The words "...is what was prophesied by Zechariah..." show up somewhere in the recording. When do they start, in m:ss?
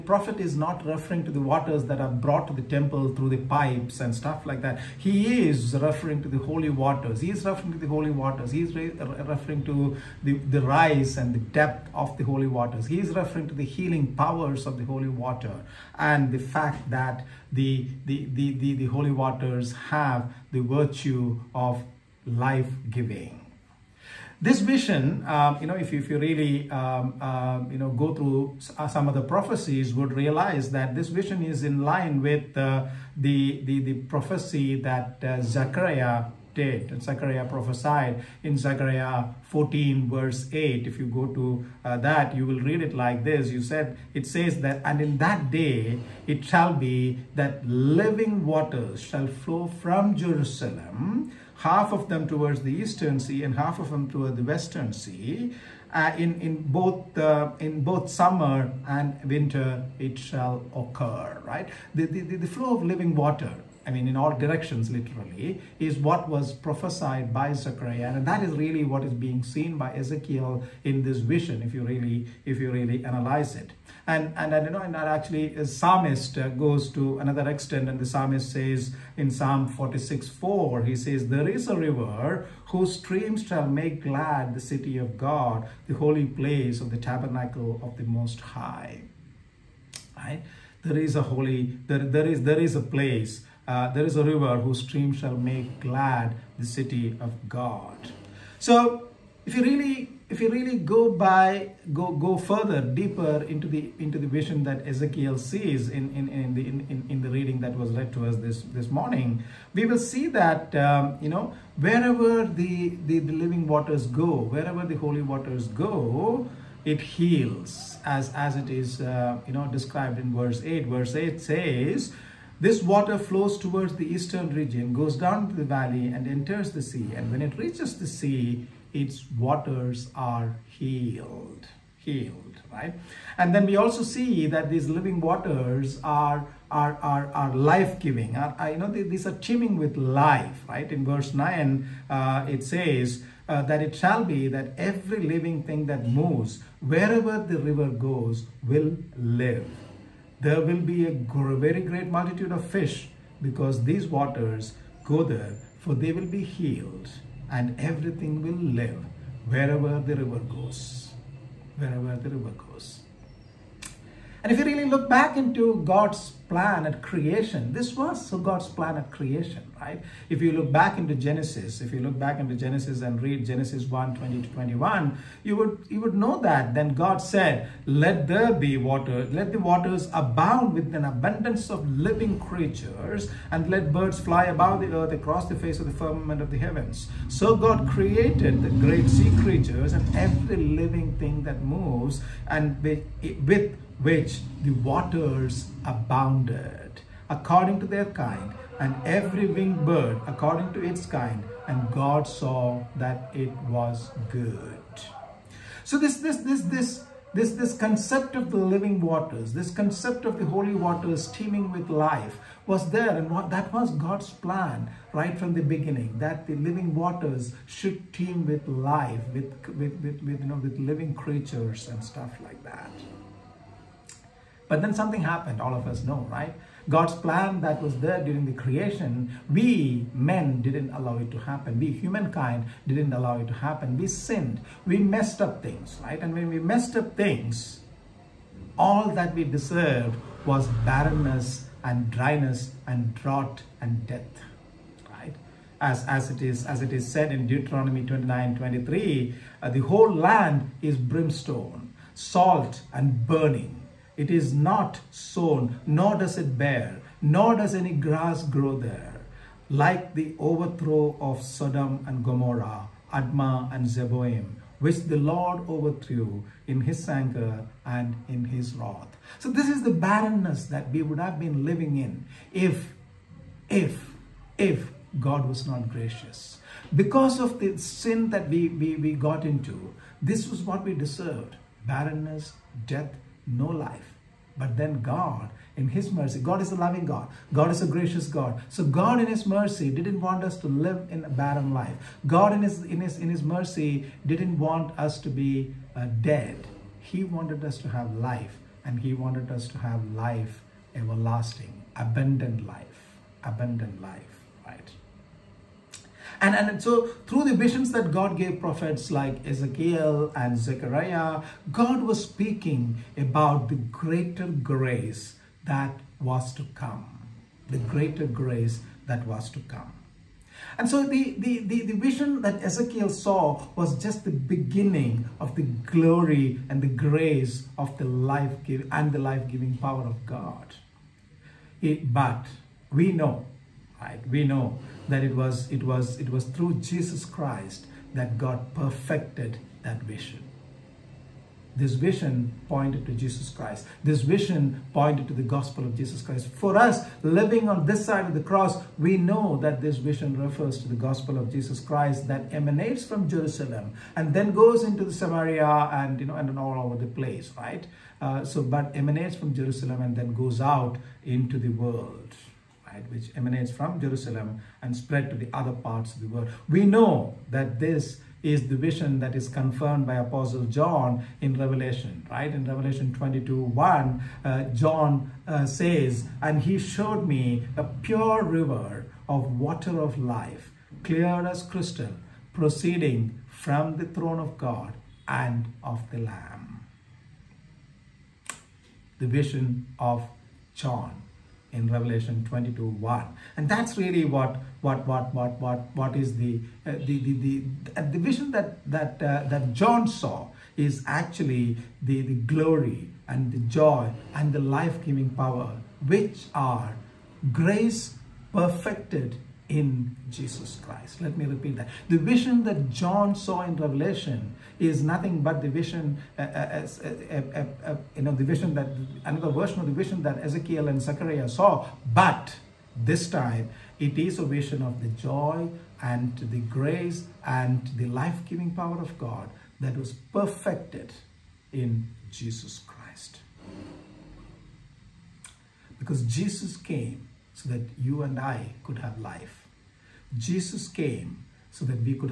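1:05.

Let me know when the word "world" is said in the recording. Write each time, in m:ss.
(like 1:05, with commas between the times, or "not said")
6:01, 6:06.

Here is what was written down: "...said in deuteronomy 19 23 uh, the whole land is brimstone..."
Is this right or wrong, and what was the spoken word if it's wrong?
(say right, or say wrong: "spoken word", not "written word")
wrong: "29", not "19".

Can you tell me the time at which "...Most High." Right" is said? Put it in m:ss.
1:28.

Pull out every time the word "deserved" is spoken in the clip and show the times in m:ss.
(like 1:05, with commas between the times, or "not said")
3:59, 4:40.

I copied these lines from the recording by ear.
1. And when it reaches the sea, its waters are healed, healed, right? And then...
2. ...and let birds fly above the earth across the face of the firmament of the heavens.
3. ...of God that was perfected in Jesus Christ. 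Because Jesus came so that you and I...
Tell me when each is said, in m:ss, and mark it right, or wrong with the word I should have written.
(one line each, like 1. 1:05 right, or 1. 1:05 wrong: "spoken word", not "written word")
1. 2:07 right
2. 3:03 right
3. 7:08 right.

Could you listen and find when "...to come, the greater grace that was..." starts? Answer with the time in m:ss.
5:16.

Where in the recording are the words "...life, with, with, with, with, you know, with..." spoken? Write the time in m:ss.
3:38.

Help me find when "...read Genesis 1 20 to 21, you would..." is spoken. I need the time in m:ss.
2:53.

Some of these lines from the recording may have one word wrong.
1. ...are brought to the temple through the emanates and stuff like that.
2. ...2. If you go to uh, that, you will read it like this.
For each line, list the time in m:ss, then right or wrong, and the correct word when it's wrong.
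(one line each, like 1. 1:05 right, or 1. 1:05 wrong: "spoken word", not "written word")
1. 0:01 wrong: "pipes", not "emanates"
2. 0:40 wrong: "8", not "2".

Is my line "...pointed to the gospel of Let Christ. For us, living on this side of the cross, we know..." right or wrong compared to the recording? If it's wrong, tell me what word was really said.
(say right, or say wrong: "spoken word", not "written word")
wrong: "Jesus", not "Let".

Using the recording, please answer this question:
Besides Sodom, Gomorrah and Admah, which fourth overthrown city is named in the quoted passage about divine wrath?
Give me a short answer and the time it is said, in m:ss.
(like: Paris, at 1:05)
Zeboim, at 4:23.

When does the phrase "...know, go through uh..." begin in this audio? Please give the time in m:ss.
0:27.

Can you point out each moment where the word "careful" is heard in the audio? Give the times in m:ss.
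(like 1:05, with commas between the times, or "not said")
not said.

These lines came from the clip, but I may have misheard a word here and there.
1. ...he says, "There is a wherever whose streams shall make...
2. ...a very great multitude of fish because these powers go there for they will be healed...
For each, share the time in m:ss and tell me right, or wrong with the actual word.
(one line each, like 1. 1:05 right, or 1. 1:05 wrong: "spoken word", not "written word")
1. 1:20 wrong: "river", not "wherever"
2. 2:31 wrong: "waters", not "powers".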